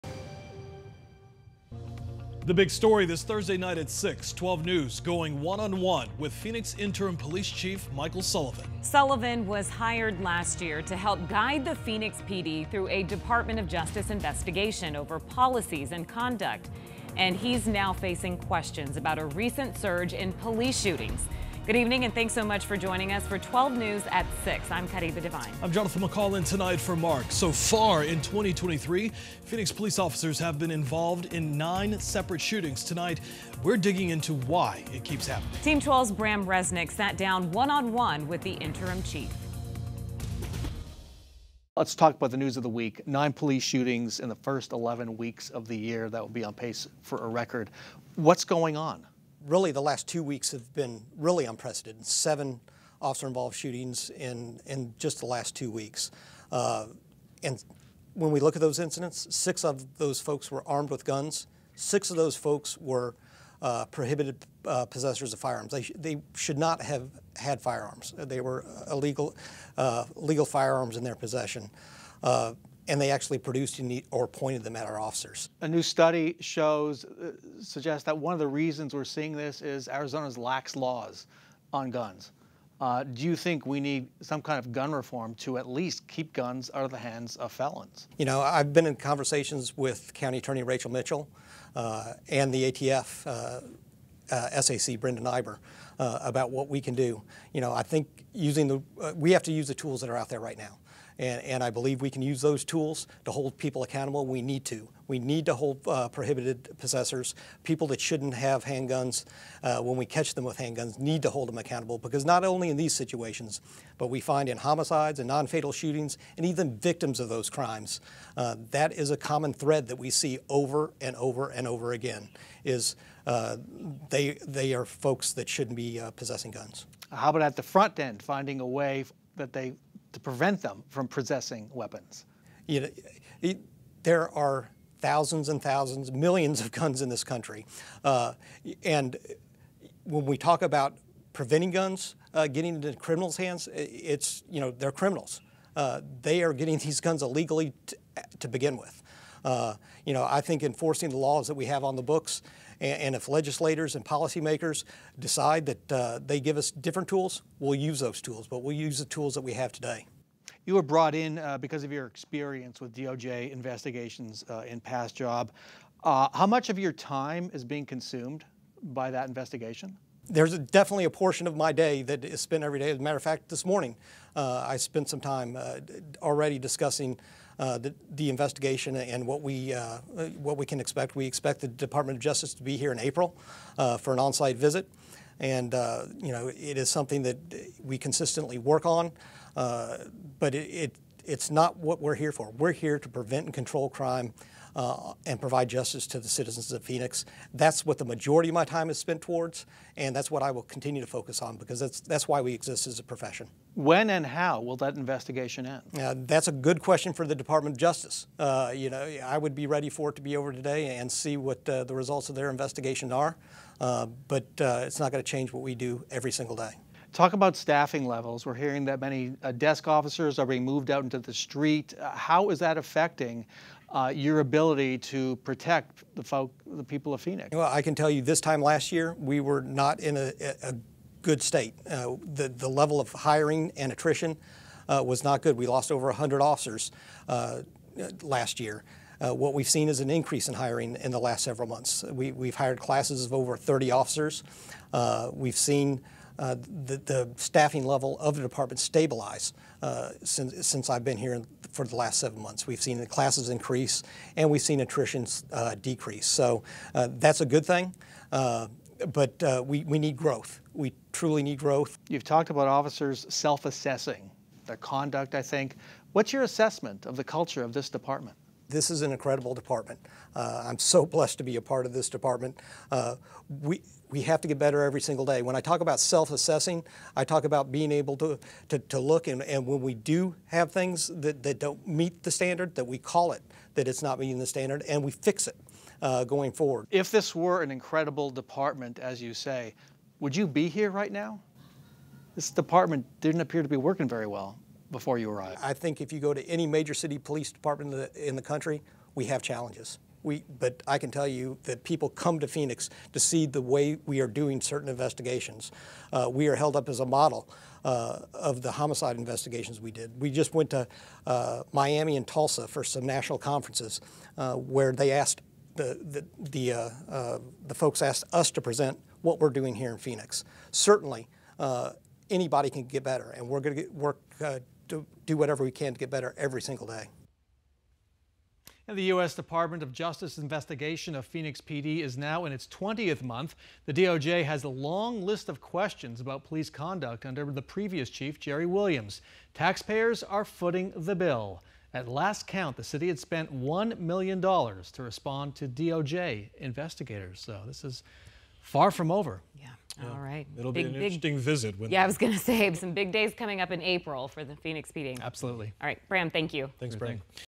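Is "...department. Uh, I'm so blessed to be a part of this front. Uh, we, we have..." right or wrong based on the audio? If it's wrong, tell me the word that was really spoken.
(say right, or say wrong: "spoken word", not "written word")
wrong: "department", not "front".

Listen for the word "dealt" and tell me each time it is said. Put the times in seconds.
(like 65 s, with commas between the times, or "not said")
not said.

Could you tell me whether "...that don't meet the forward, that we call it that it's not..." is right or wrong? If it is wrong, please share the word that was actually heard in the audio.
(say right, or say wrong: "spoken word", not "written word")
wrong: "standard", not "forward".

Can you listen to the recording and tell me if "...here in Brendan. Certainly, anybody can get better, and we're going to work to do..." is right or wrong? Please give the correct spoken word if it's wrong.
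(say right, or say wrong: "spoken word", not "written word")
wrong: "Phoenix", not "Brendan".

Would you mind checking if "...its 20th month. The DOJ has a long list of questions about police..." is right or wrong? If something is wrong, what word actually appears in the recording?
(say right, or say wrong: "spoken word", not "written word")
right.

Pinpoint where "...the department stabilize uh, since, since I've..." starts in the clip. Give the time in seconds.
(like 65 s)
248 s.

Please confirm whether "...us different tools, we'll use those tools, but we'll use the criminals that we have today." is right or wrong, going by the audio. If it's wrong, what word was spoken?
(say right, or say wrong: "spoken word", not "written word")
wrong: "tools", not "criminals".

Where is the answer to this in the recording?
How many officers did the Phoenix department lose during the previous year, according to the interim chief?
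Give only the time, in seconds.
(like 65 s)
235 s.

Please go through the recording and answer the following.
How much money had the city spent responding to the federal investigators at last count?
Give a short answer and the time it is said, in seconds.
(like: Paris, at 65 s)
$1 million, at 343 s.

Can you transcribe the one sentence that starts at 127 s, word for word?
How about at the front end, finding a way that they, to prevent them from possessing weapons?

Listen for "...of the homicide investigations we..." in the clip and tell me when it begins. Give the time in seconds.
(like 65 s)
308 s.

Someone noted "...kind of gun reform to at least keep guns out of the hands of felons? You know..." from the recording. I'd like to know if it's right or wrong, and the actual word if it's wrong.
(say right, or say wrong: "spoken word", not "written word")
right.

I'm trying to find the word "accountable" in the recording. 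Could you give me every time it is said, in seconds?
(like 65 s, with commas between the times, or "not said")
103 s, 111 s.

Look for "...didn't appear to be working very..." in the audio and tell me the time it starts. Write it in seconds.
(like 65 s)
293 s.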